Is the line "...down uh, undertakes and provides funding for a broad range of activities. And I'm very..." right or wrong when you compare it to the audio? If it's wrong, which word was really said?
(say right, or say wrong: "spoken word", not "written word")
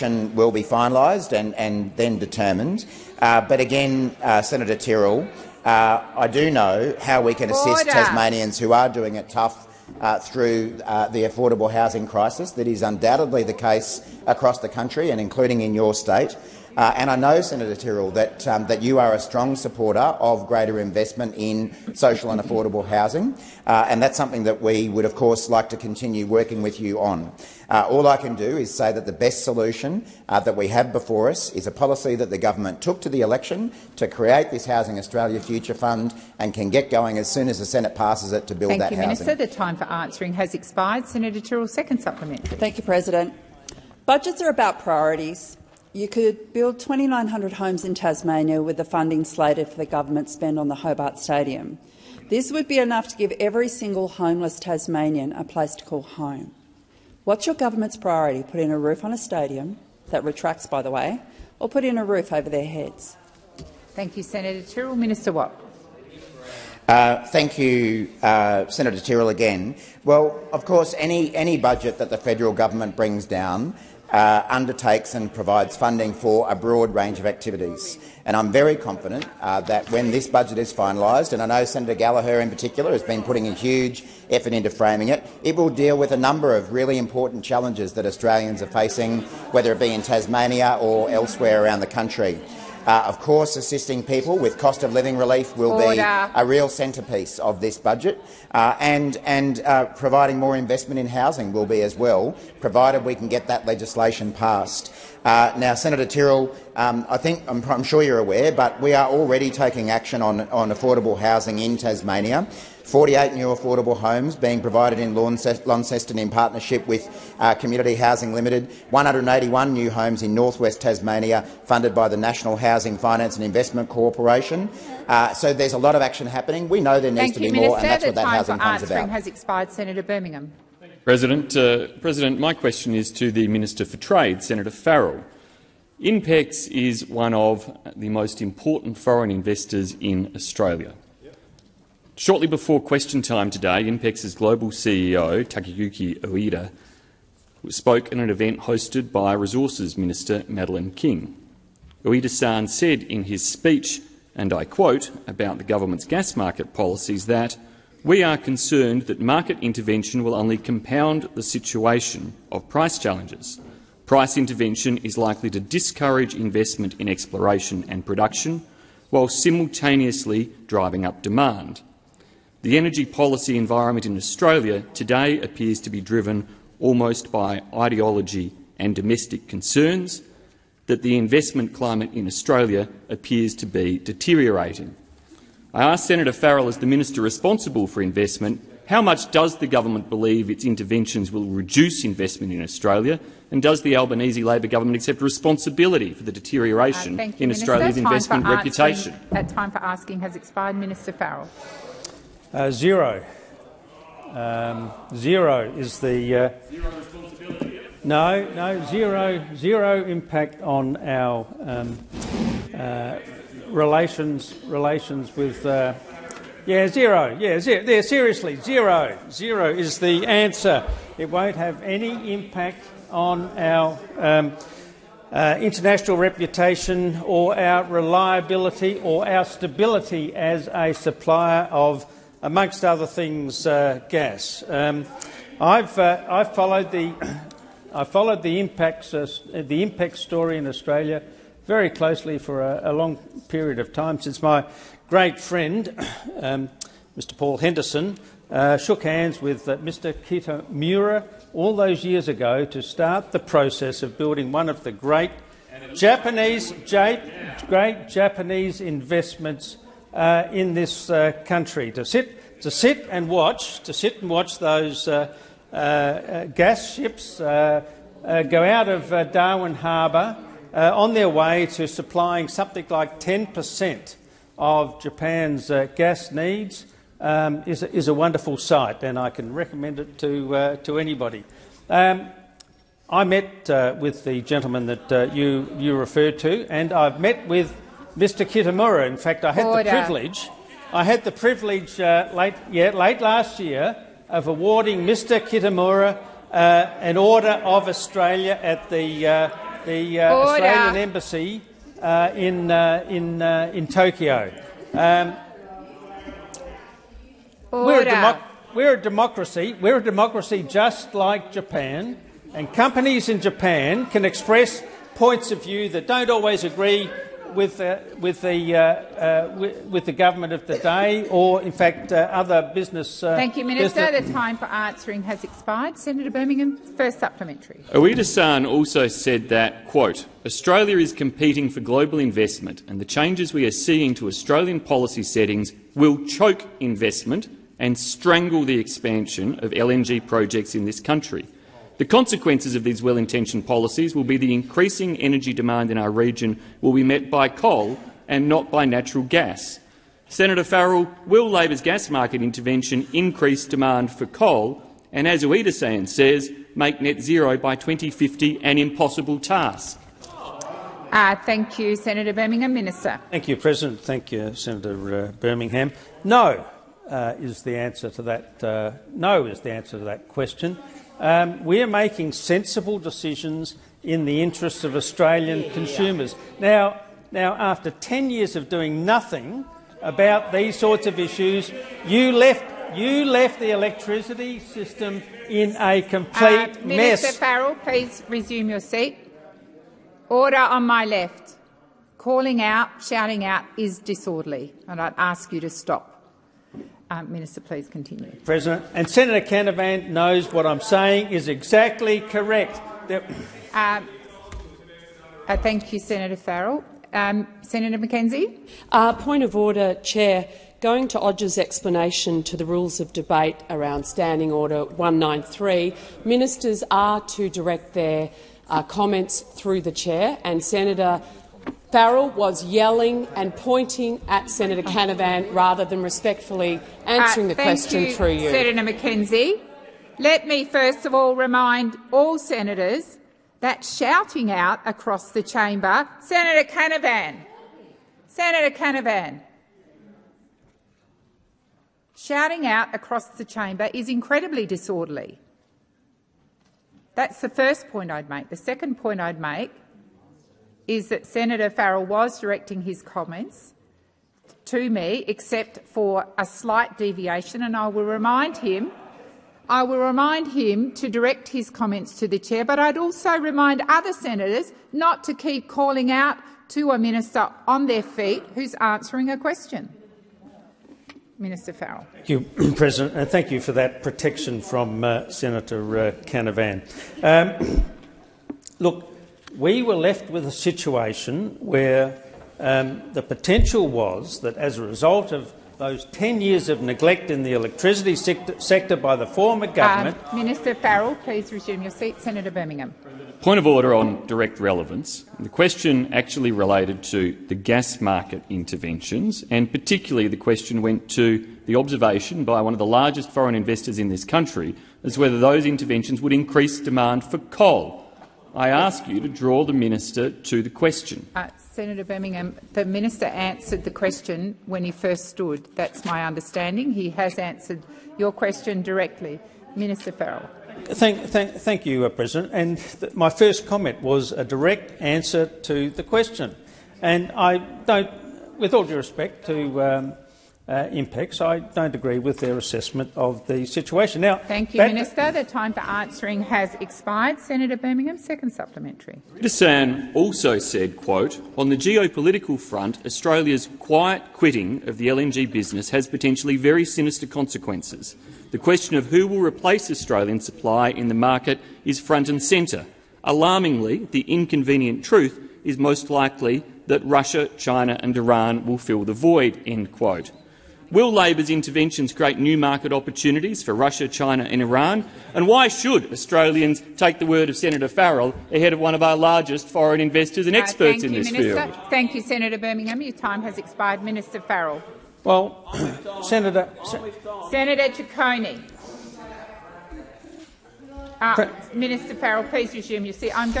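right.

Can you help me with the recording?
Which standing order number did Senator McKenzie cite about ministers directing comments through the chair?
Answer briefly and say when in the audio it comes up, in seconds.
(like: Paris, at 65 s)
193, at 414 s.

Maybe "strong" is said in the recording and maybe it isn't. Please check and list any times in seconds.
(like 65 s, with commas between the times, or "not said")
19 s.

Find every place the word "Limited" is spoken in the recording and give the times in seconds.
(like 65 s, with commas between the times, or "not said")
118 s.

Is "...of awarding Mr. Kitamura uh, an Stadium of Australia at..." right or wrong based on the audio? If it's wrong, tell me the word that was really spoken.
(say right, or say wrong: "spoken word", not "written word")
wrong: "Order", not "Stadium".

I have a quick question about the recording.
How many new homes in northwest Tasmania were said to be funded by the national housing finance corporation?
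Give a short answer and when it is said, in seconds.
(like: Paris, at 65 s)
181, at 118 s.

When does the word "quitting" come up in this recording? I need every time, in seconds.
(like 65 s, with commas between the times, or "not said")
544 s.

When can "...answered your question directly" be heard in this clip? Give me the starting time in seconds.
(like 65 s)
517 s.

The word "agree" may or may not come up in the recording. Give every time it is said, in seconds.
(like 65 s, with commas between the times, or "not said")
316 s, 531 s.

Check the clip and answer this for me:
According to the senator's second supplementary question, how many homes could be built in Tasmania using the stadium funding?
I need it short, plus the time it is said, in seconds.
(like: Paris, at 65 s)
2,900, at 46 s.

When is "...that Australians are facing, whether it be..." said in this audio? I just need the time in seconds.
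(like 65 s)
87 s.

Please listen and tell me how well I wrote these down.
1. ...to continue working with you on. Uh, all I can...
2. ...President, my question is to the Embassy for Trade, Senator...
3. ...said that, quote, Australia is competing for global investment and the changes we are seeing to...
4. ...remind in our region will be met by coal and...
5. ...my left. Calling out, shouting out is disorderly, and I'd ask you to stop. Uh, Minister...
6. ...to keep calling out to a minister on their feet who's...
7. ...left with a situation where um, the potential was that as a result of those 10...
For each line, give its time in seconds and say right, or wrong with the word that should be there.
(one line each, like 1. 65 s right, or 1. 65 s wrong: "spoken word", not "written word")
1. 25 s right
2. 132 s wrong: "Minister", not "Embassy"
3. 329 s right
4. 345 s wrong: "demand", not "remind"
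5. 390 s right
6. 465 s right
7. 479 s right.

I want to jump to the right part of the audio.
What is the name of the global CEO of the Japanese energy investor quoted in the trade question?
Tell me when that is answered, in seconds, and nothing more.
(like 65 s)
145 s.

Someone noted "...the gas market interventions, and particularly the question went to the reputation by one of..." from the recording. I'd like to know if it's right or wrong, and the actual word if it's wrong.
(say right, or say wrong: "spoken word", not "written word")
wrong: "observation", not "reputation".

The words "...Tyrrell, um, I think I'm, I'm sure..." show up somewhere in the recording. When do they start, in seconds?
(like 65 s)
106 s.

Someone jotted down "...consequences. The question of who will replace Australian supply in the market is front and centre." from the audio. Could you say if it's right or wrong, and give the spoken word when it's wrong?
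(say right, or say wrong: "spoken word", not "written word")
right.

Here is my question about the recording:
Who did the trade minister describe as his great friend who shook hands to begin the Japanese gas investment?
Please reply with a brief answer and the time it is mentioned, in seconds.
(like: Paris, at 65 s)
Paul Henderson, at 247 s.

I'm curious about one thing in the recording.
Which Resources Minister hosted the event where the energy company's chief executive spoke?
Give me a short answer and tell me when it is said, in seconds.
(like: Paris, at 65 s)
Madeline King, at 150 s.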